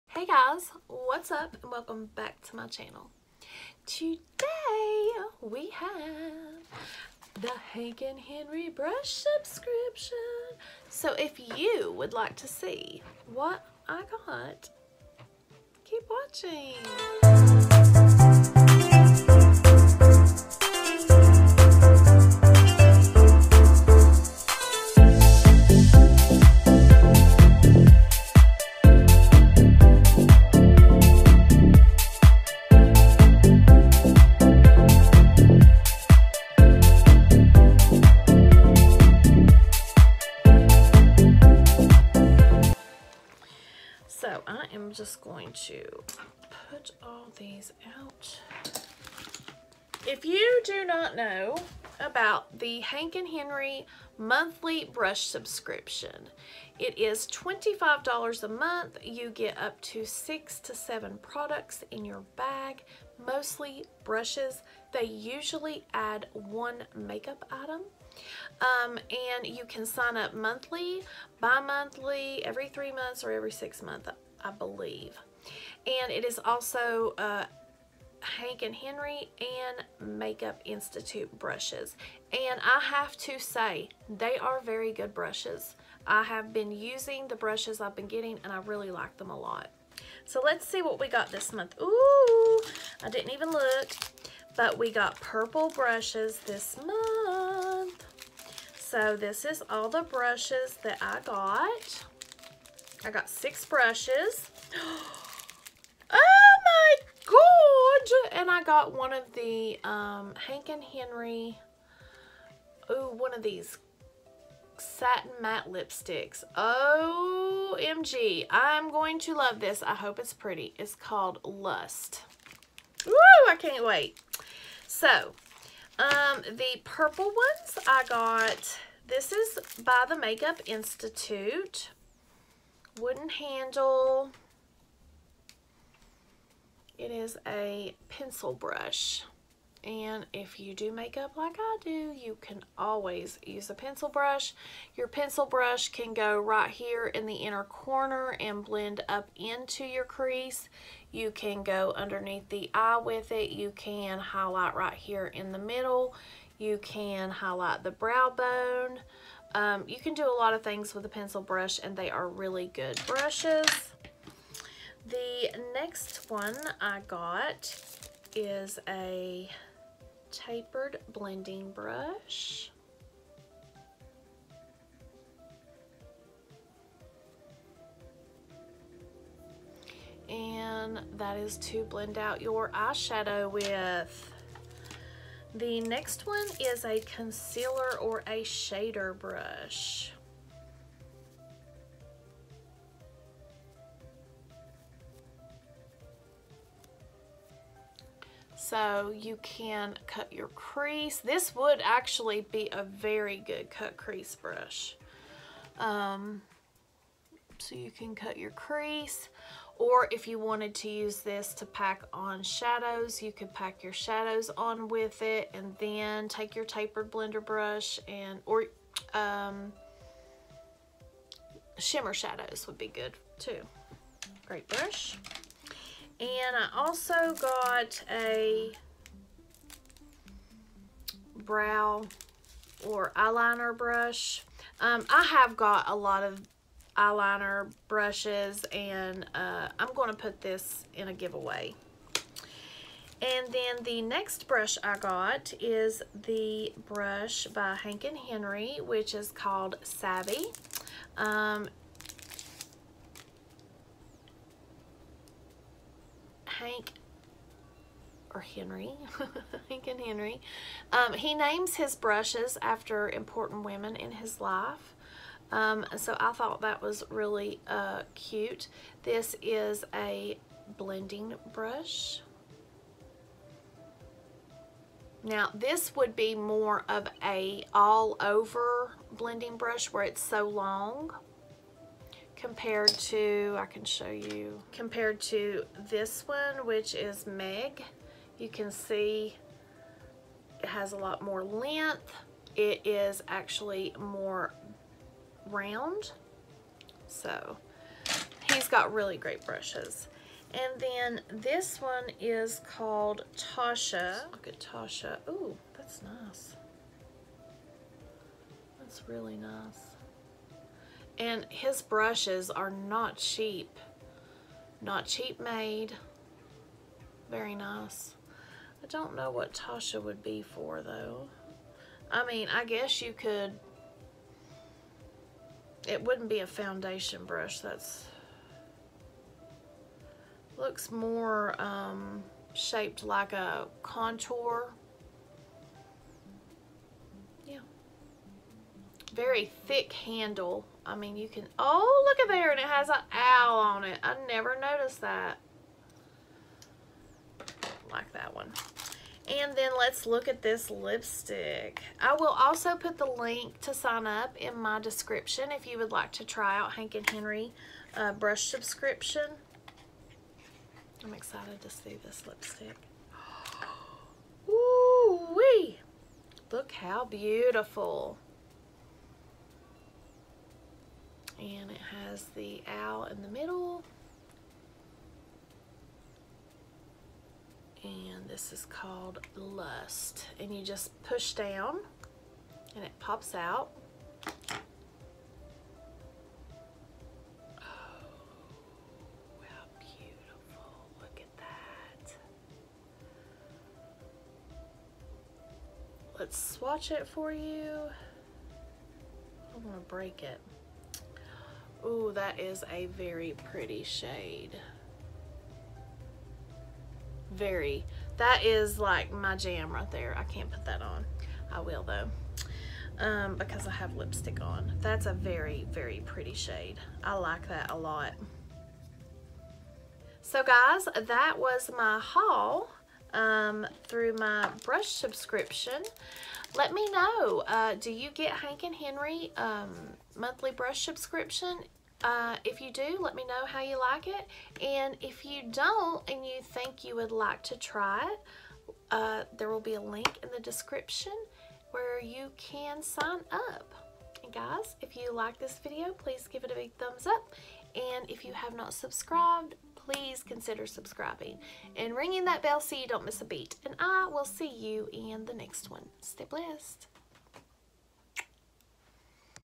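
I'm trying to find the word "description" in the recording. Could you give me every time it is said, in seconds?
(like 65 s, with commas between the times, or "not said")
354 s, 440 s.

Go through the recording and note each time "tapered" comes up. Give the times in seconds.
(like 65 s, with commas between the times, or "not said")
170 s, 216 s.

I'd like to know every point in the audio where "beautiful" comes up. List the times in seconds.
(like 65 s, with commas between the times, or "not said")
367 s, 389 s.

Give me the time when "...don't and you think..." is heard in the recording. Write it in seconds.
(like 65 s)
435 s.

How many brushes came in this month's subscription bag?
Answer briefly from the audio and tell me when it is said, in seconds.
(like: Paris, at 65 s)
6, at 103 s.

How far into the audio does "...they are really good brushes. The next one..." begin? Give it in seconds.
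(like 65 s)
161 s.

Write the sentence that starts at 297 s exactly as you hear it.
So he's got really great brushes.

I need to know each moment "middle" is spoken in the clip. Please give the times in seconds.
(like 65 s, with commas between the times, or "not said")
155 s, 373 s.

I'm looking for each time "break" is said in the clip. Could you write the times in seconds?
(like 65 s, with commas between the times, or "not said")
399 s.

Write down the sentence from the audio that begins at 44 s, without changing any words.
So I am just going to put all these out.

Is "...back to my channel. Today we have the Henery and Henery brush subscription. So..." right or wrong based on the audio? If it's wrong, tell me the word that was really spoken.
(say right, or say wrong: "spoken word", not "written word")
wrong: "Hank", not "Henery".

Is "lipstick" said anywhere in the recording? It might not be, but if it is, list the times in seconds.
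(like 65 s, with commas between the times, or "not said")
115 s, 350 s, 362 s, 413 s.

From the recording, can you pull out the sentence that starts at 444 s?
And guys, if you like this video, please give it a big thumbs up.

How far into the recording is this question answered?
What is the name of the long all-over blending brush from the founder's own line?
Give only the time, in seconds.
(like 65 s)
248 s.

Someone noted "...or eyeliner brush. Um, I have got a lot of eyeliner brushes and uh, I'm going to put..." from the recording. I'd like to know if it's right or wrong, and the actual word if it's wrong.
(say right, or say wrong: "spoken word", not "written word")
right.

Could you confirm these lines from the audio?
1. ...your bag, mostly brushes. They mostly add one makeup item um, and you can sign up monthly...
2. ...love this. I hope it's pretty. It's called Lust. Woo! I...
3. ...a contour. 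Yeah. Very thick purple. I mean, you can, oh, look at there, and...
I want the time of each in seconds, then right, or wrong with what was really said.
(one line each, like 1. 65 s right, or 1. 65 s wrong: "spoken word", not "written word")
1. 62 s wrong: "usually", not "mostly"
2. 119 s right
3. 333 s wrong: "handle", not "purple".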